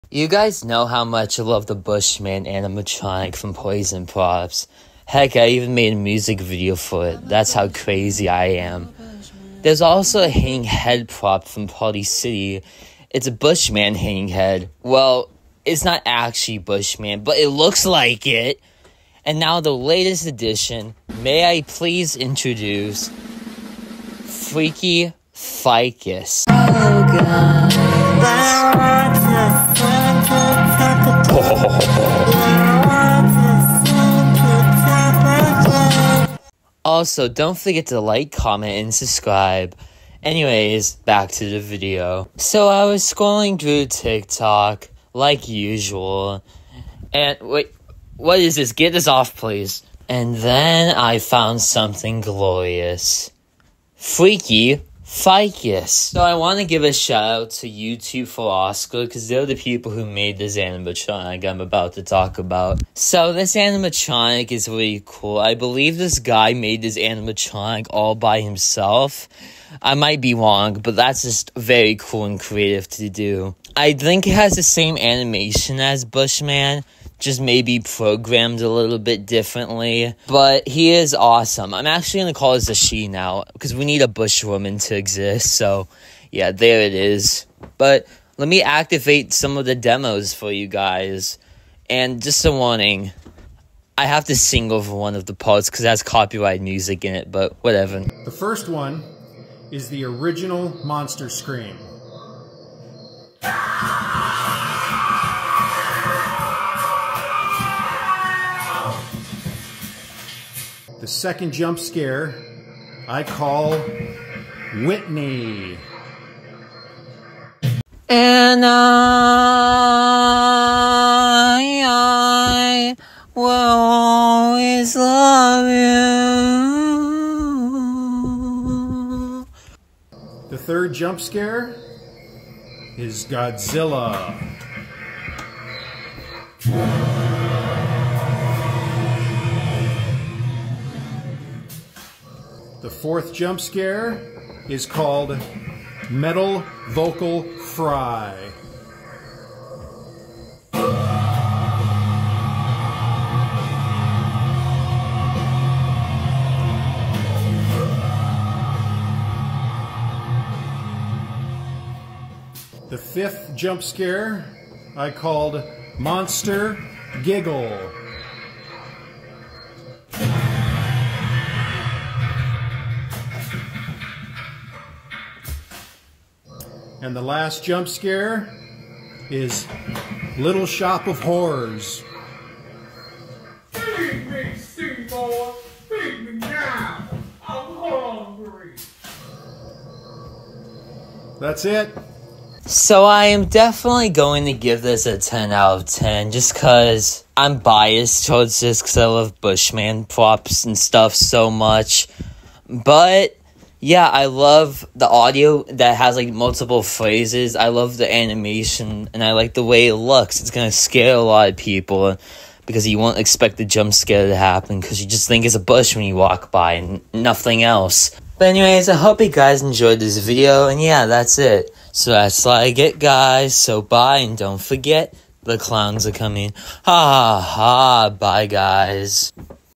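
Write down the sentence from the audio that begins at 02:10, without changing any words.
The third jump scare is Godzilla.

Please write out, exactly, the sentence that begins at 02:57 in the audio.
And the last jump scare is Little Shop of Horrors.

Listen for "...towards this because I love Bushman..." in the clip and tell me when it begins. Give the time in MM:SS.
03:18.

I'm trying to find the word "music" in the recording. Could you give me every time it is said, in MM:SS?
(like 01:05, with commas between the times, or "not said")
00:05, 01:36.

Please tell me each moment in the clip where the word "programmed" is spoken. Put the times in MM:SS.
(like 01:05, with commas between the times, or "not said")
01:17.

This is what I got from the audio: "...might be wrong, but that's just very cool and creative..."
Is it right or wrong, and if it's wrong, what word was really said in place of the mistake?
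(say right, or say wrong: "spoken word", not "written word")
right.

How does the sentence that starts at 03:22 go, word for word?
But yeah, I love the audio that has like multiple phrases.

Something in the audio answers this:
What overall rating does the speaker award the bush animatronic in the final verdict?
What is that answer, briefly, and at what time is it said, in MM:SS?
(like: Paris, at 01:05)
10 out of 10, at 03:15.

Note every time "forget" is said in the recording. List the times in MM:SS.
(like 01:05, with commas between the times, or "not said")
00:37, 03:44.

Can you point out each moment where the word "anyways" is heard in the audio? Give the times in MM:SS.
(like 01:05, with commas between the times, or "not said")
00:40, 03:38.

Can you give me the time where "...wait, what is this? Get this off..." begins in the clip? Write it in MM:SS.
00:47.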